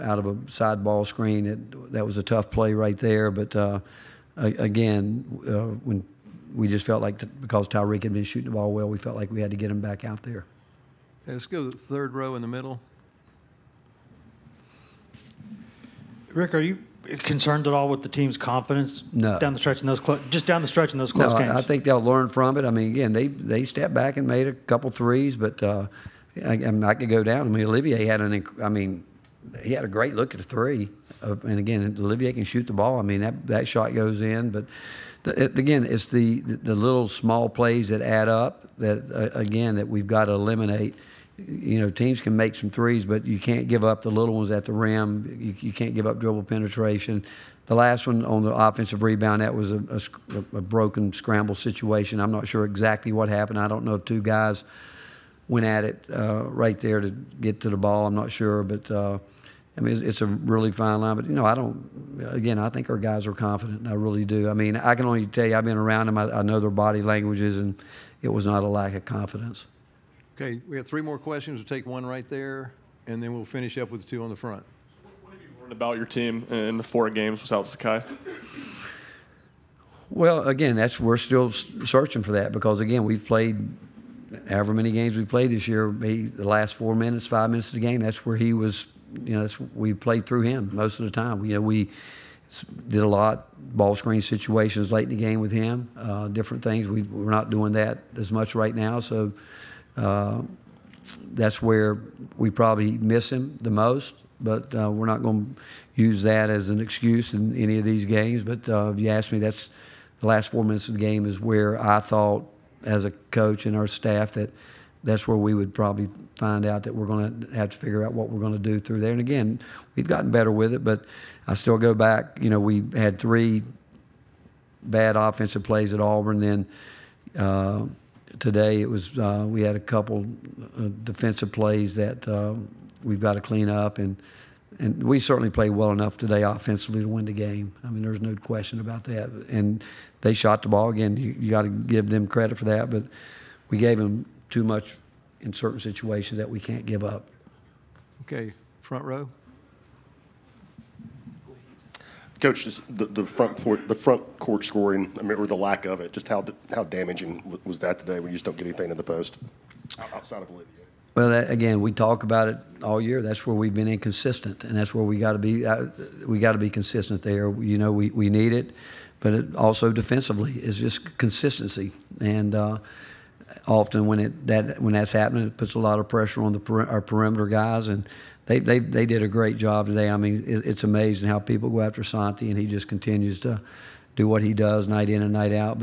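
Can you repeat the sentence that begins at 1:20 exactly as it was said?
Well, again, that's we're still searching for that because again, we've played however many games we played this year.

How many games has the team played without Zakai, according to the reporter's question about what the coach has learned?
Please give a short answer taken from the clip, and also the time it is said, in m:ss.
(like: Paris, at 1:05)
4, at 1:16.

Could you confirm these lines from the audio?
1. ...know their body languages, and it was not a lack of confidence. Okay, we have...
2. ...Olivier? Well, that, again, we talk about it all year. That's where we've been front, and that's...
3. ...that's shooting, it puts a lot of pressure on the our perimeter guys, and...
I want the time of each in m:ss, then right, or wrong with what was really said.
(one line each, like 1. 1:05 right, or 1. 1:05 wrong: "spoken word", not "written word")
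1. 1:06 right
2. 2:40 wrong: "inconsistent", not "front"
3. 2:54 wrong: "happening", not "shooting".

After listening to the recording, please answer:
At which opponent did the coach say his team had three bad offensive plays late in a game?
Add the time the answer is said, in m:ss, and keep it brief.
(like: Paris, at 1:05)
Auburn, at 2:06.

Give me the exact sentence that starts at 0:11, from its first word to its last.
Okay, let's go to the third row in the middle.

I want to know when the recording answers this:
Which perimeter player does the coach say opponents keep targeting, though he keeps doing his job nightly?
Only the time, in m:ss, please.
3:02.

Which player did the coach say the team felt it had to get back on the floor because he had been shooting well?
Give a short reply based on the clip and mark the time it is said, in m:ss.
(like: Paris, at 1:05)
Tyreke, at 0:07.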